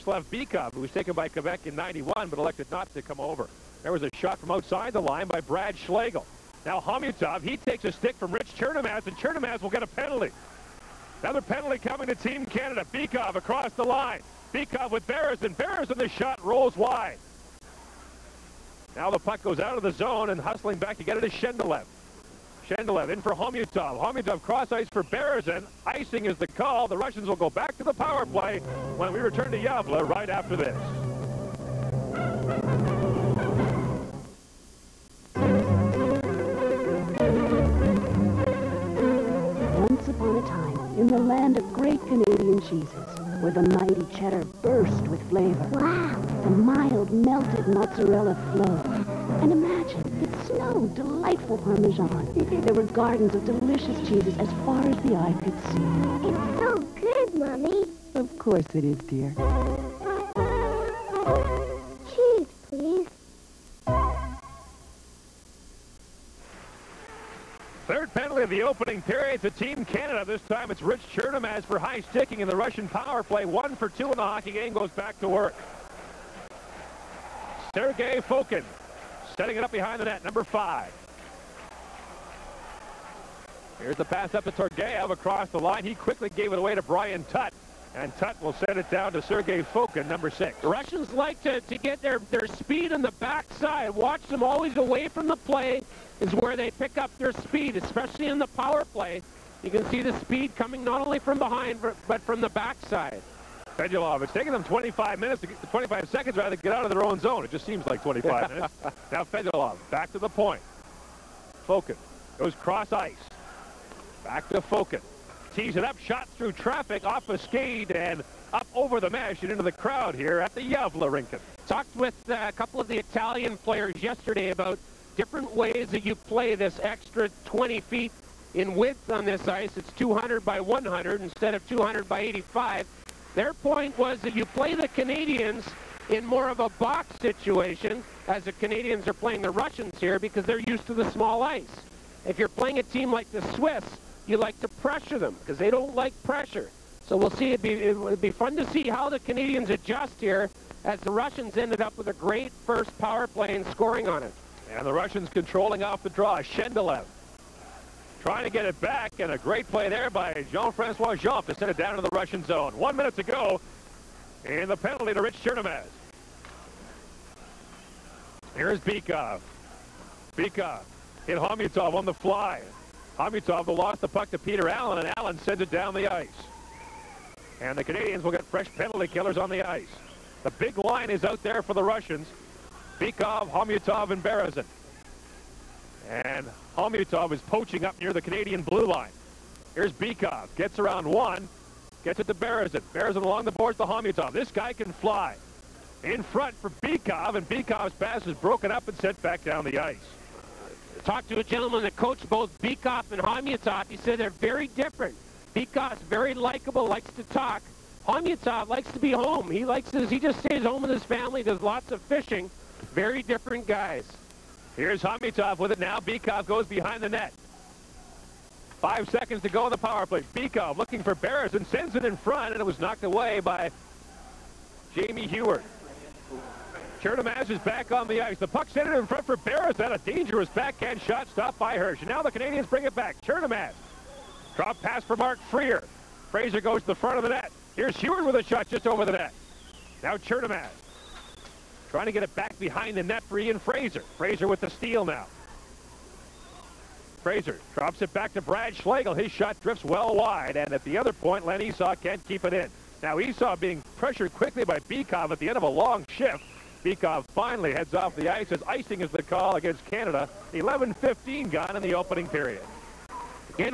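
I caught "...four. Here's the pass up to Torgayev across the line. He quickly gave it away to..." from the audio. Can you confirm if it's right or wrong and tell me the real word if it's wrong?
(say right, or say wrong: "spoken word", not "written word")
wrong: "five", not "four".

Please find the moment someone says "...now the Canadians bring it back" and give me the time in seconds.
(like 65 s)
232 s.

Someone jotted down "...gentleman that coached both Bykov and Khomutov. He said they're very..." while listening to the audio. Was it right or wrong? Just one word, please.
right.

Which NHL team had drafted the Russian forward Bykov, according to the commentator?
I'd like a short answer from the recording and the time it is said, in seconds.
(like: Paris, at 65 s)
Quebec, at 1 s.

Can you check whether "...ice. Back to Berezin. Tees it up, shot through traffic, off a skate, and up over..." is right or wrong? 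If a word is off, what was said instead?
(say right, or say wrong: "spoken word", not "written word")
wrong: "Fokin", not "Berezin".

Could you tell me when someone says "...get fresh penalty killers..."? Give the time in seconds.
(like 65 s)
178 s.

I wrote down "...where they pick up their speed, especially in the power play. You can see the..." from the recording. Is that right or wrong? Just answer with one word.
right.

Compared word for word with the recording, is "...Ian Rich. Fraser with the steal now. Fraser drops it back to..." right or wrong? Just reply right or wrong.
wrong.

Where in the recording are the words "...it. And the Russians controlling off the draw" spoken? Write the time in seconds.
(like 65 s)
154 s.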